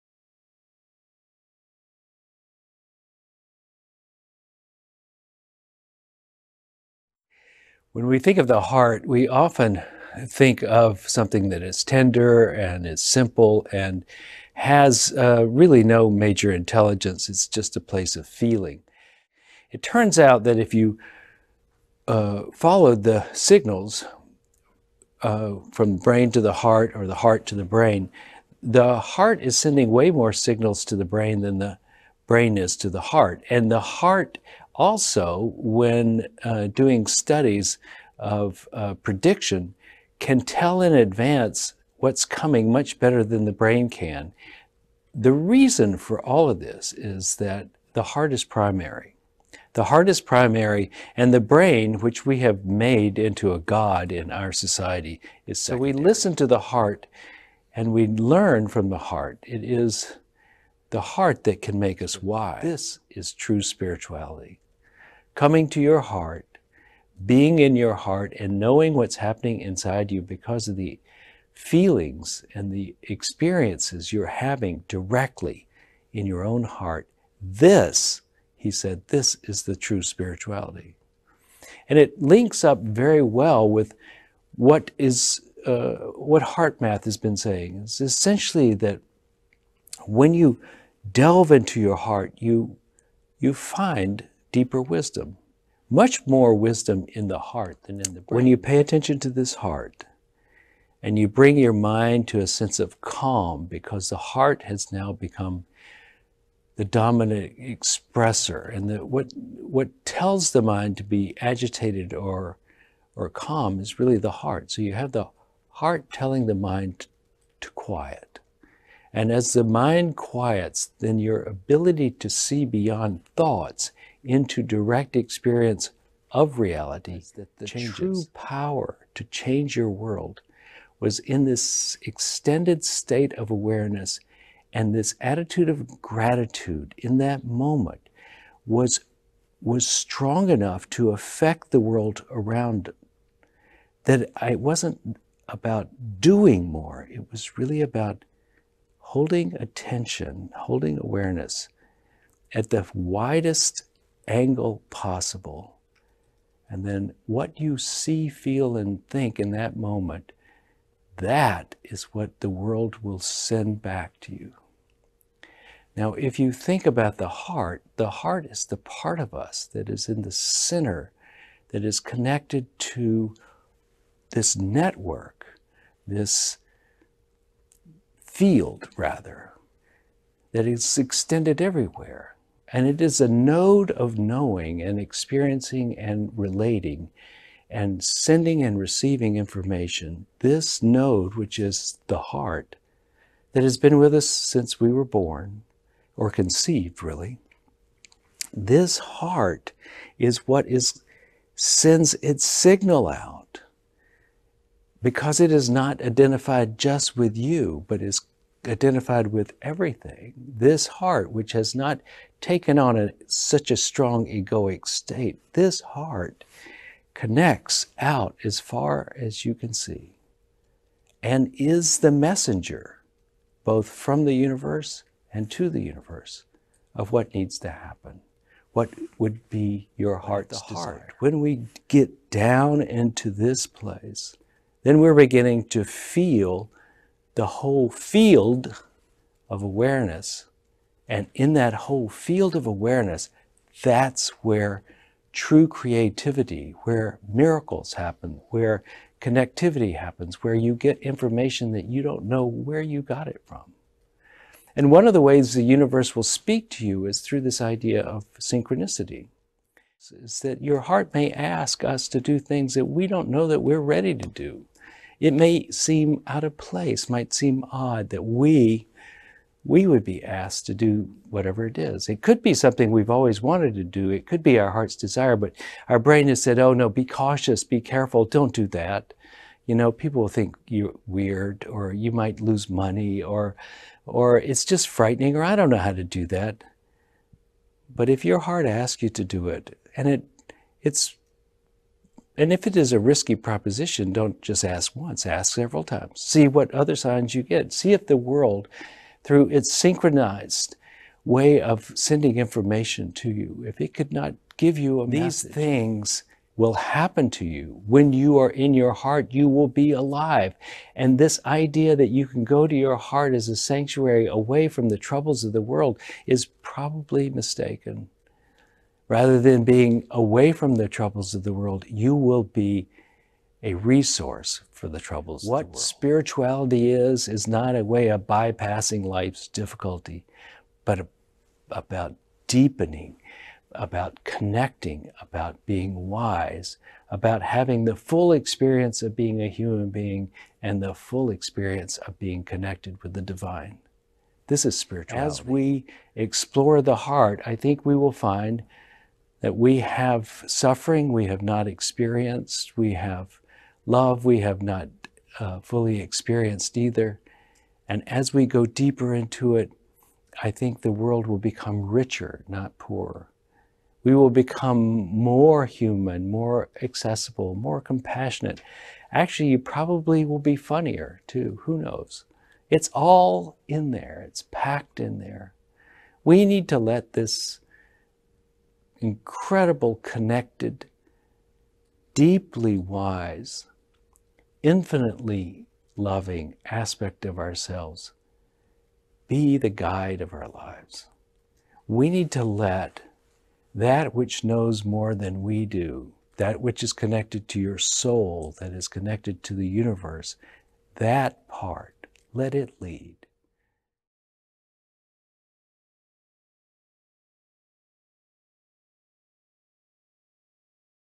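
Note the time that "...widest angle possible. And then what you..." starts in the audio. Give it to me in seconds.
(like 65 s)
152 s.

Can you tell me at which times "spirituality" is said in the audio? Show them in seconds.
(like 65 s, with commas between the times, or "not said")
63 s, 80 s, 325 s, 344 s.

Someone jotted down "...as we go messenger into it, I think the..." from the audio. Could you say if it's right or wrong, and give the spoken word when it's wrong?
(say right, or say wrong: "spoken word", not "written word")
wrong: "deeper", not "messenger".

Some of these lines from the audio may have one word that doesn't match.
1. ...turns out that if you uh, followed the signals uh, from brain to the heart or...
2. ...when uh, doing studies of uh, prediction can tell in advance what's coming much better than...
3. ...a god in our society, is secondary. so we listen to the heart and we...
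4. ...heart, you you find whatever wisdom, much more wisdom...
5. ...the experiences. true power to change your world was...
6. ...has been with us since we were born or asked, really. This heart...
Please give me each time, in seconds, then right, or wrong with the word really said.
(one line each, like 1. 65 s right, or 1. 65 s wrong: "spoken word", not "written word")
1. 19 s right
2. 35 s right
3. 53 s right
4. 91 s wrong: "deeper", not "whatever"
5. 127 s wrong: "changes", not "experiences"
6. 193 s wrong: "conceived", not "asked".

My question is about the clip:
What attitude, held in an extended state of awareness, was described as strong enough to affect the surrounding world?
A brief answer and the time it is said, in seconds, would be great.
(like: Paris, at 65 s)
Gratitude, at 135 s.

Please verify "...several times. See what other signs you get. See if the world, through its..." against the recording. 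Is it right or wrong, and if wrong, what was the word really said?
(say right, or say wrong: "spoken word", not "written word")
right.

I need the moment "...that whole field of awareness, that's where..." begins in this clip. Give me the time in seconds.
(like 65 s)
241 s.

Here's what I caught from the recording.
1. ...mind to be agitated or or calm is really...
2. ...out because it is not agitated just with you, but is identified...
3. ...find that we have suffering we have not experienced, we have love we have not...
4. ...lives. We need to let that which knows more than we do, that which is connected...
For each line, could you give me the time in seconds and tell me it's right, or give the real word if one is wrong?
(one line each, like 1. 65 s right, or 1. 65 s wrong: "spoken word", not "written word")
1. 110 s right
2. 203 s wrong: "identified", not "agitated"
3. 348 s right
4. 390 s right.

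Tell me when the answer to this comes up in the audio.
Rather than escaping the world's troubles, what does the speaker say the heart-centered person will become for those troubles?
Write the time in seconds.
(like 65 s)
323 s.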